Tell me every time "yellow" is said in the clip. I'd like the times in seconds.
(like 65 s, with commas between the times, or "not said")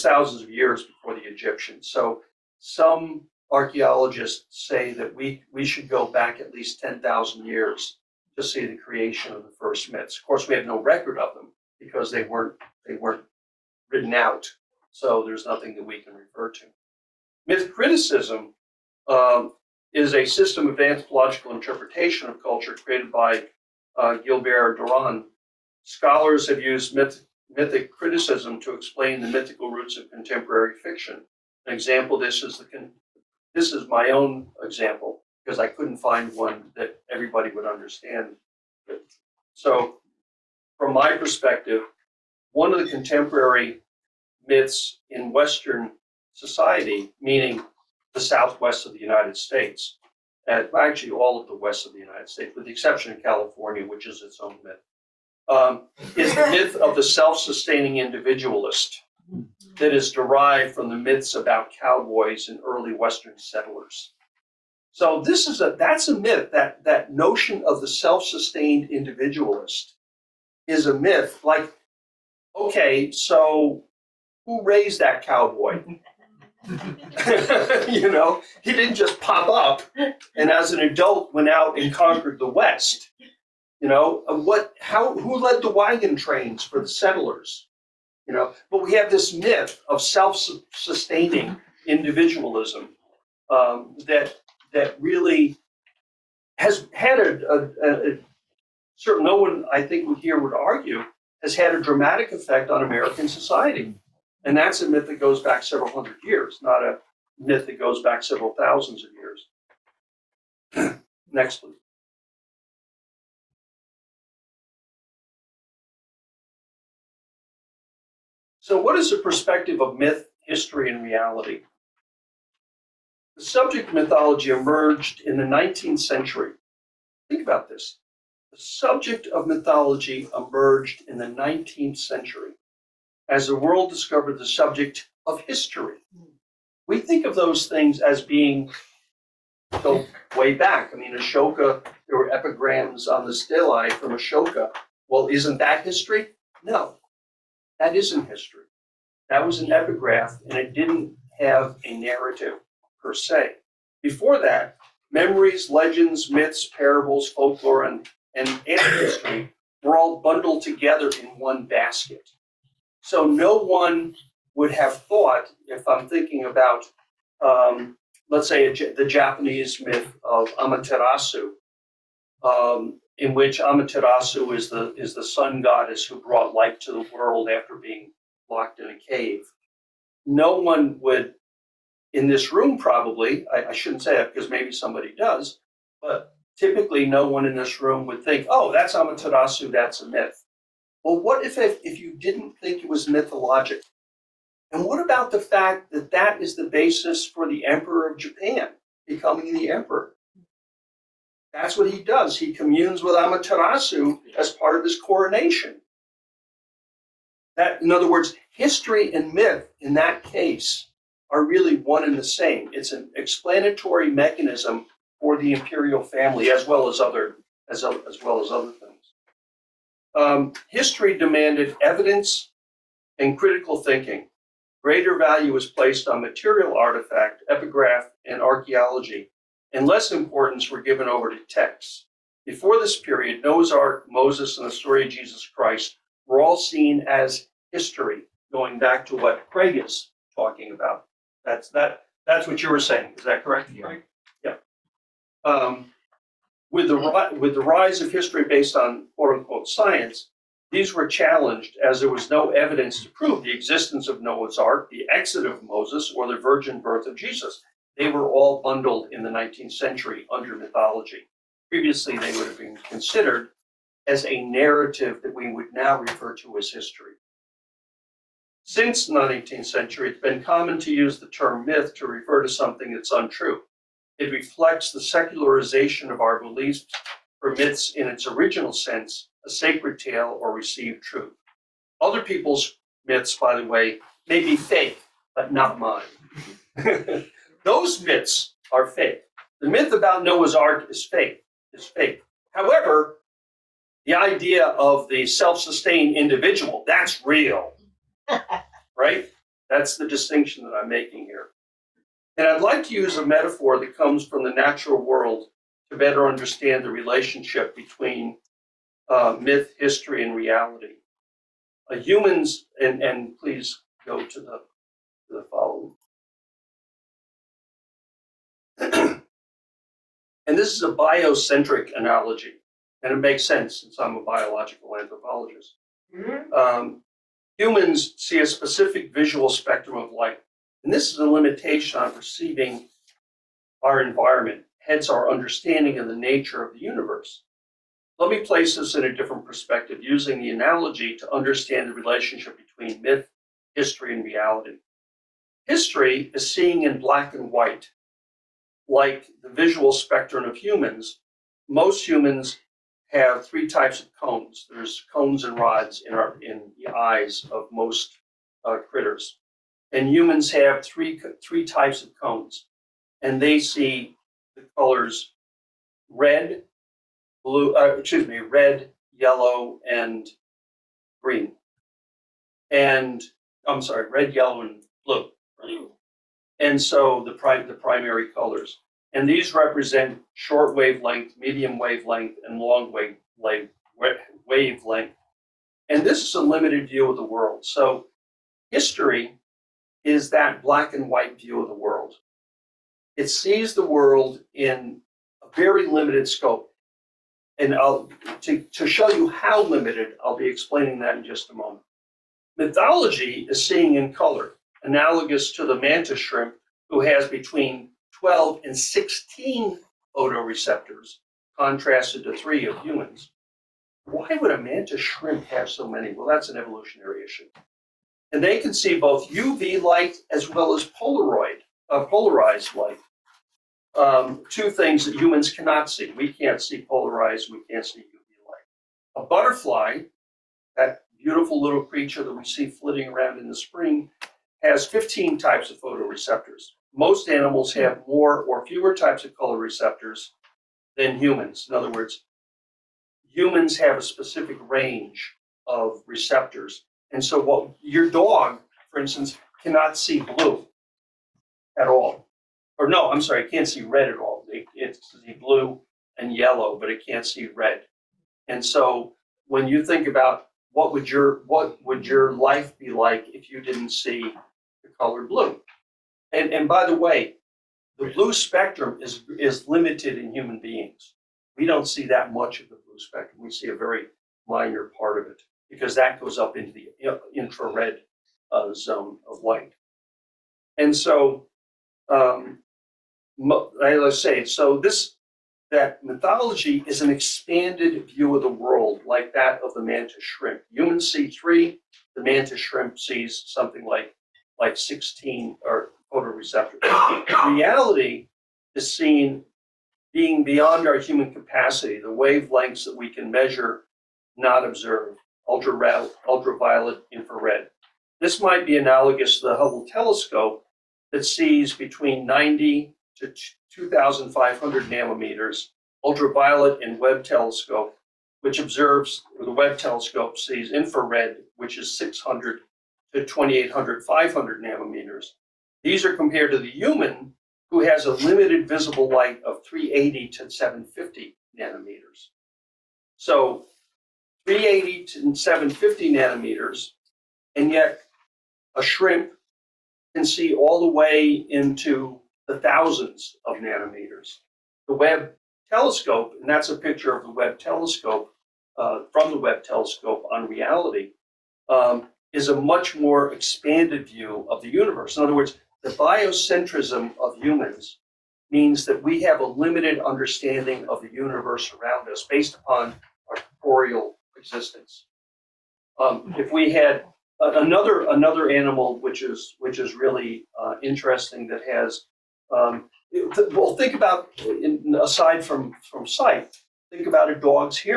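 369 s, 374 s, 456 s.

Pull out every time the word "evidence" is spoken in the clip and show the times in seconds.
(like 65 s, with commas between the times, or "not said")
221 s, 252 s.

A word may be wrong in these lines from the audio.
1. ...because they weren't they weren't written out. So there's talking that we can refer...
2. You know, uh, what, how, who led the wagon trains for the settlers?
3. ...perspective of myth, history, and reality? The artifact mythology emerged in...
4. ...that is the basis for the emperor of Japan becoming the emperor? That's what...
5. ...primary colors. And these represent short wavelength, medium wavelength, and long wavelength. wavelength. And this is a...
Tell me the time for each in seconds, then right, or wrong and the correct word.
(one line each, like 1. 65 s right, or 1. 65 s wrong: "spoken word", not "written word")
1. 11 s wrong: "nothing", not "talking"
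2. 83 s right
3. 119 s wrong: "subject", not "artifact"
4. 196 s right
5. 377 s right.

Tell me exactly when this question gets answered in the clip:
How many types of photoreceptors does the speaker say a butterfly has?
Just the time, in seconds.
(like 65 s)
434 s.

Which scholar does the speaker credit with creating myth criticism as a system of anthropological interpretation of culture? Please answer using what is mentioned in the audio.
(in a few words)
Gilbert Durand.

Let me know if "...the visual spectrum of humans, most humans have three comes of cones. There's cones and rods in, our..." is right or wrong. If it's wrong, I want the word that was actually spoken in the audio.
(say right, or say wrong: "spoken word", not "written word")
wrong: "types", not "comes".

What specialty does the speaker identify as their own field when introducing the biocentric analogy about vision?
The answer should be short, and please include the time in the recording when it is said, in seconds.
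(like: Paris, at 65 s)
biological anthropologist, at 324 s.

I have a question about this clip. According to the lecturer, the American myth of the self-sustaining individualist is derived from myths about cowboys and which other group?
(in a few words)
early Western settlers.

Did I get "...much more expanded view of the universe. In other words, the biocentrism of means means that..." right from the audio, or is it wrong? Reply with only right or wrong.
wrong.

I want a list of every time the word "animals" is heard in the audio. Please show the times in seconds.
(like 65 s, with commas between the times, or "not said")
437 s, 568 s.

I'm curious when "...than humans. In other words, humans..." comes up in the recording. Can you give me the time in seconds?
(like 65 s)
440 s.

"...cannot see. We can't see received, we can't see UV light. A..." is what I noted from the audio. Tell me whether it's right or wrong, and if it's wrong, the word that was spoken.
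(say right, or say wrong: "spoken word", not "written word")
wrong: "polarized", not "received".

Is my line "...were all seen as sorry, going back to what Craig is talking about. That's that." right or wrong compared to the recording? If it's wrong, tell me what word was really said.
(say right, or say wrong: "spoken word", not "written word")
wrong: "history", not "sorry".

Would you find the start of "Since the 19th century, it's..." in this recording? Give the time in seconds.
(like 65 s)
268 s.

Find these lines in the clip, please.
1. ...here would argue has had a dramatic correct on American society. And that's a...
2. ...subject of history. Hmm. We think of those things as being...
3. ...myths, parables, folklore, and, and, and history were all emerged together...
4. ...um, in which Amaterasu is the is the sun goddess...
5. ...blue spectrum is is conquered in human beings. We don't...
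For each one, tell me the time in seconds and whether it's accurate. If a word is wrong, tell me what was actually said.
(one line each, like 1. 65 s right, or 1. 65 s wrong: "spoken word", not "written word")
1. 100 s wrong: "effect", not "correct"
2. 134 s right
3. 156 s wrong: "bundled", not "emerged"
4. 172 s right
5. 468 s wrong: "limited", not "conquered".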